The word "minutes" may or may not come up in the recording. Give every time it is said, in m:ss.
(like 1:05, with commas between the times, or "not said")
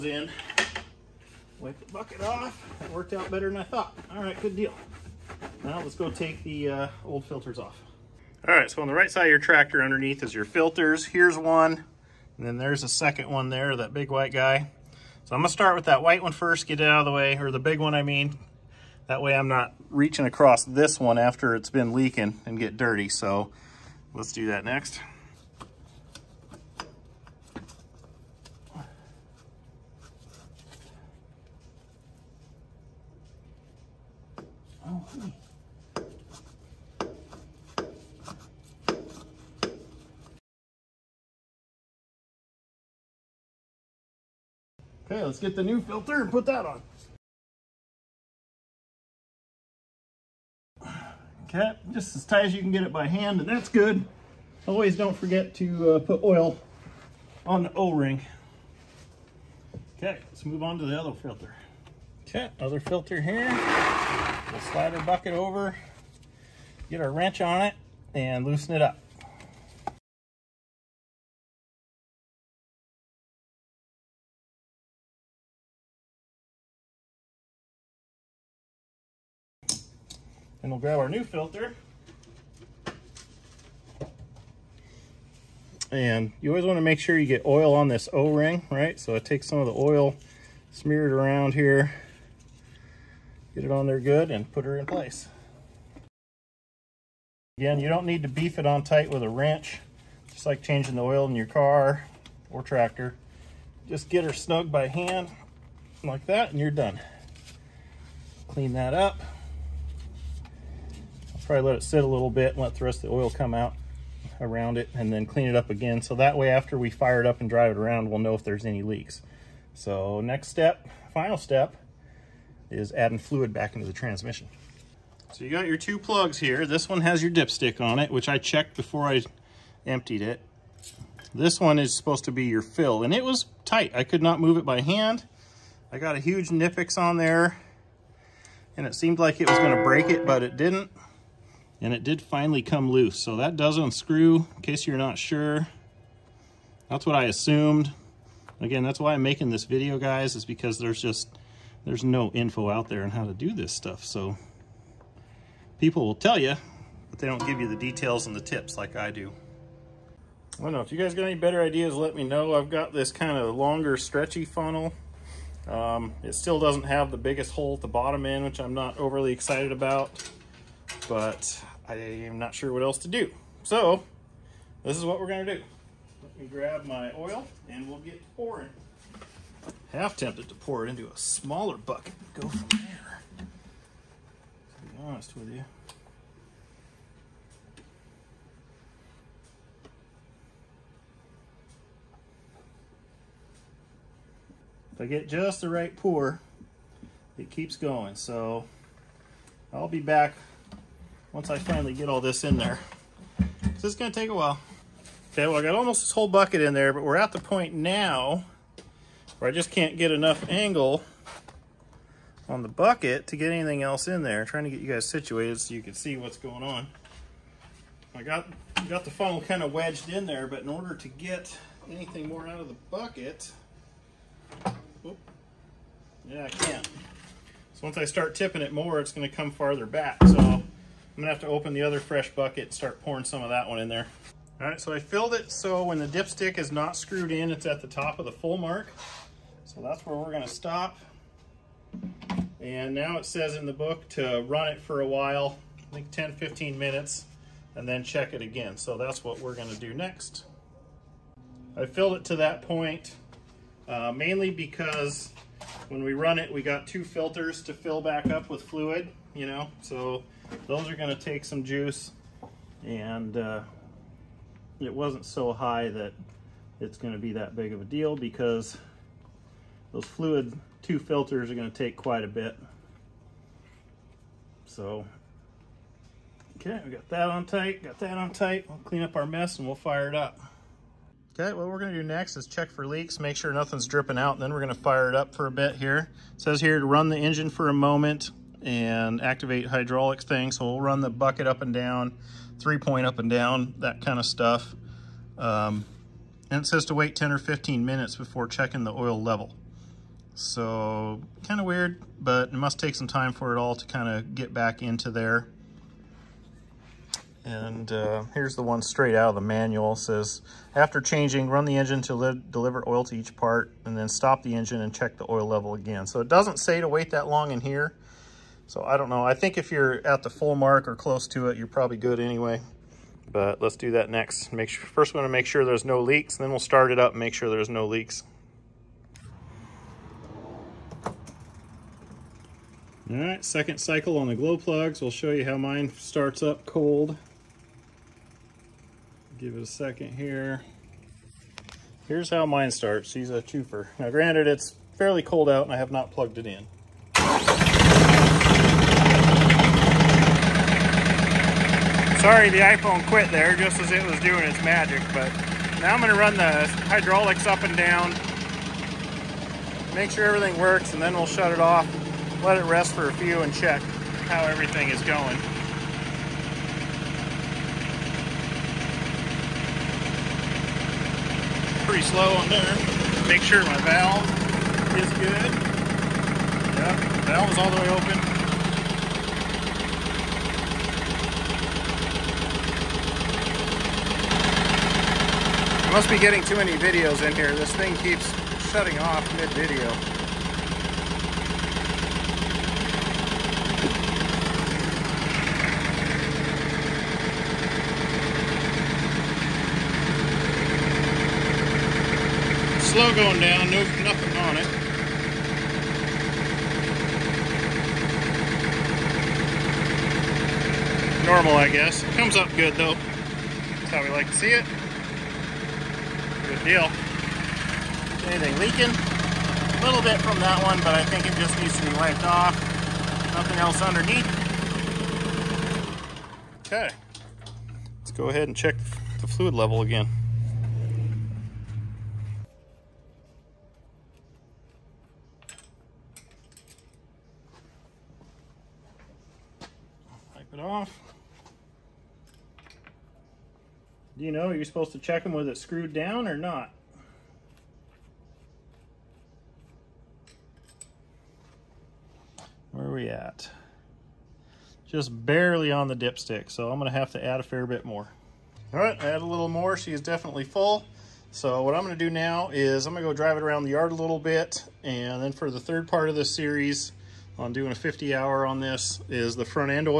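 4:06, 4:57.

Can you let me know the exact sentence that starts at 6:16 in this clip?
Yep, valve is all the way open.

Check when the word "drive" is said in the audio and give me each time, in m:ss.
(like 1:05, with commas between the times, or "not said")
1:57, 7:43.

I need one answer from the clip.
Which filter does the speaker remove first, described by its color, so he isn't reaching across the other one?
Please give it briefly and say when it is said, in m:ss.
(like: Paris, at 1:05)
White one, at 0:16.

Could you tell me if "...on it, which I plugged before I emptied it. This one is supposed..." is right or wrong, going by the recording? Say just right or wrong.
wrong.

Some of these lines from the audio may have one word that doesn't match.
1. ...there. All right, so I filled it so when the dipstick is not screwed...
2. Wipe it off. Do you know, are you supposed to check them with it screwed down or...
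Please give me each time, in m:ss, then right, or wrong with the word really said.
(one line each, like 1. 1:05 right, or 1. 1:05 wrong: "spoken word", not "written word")
1. 3:53 right
2. 7:20 right.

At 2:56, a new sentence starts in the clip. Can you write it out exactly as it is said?
Let me grab my oil and we'll get pouring.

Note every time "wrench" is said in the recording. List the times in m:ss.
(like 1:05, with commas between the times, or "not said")
1:07, 1:39.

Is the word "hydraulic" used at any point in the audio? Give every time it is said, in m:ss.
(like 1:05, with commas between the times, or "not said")
4:49, 5:56.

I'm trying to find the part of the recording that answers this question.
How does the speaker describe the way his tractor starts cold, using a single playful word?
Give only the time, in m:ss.
5:43.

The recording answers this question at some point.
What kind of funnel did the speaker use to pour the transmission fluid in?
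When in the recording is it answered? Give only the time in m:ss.
2:43.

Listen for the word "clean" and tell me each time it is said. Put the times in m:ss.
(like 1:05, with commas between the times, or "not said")
1:48, 1:55, 4:38.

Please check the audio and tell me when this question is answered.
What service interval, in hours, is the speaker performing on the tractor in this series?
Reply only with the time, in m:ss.
7:47.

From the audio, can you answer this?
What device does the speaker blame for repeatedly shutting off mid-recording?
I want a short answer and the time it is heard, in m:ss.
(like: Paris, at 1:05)
iPhone, at 5:52.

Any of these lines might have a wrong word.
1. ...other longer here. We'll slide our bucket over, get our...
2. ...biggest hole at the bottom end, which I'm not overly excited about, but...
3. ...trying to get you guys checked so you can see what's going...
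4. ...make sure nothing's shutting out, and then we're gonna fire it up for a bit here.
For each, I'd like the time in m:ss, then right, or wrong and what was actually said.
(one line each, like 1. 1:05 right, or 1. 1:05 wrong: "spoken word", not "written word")
1. 1:02 wrong: "filter", not "longer"
2. 2:47 right
3. 3:34 wrong: "situated", not "checked"
4. 4:43 wrong: "dripping", not "shutting".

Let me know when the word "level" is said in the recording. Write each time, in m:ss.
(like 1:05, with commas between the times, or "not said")
4:59, 5:15, 7:09.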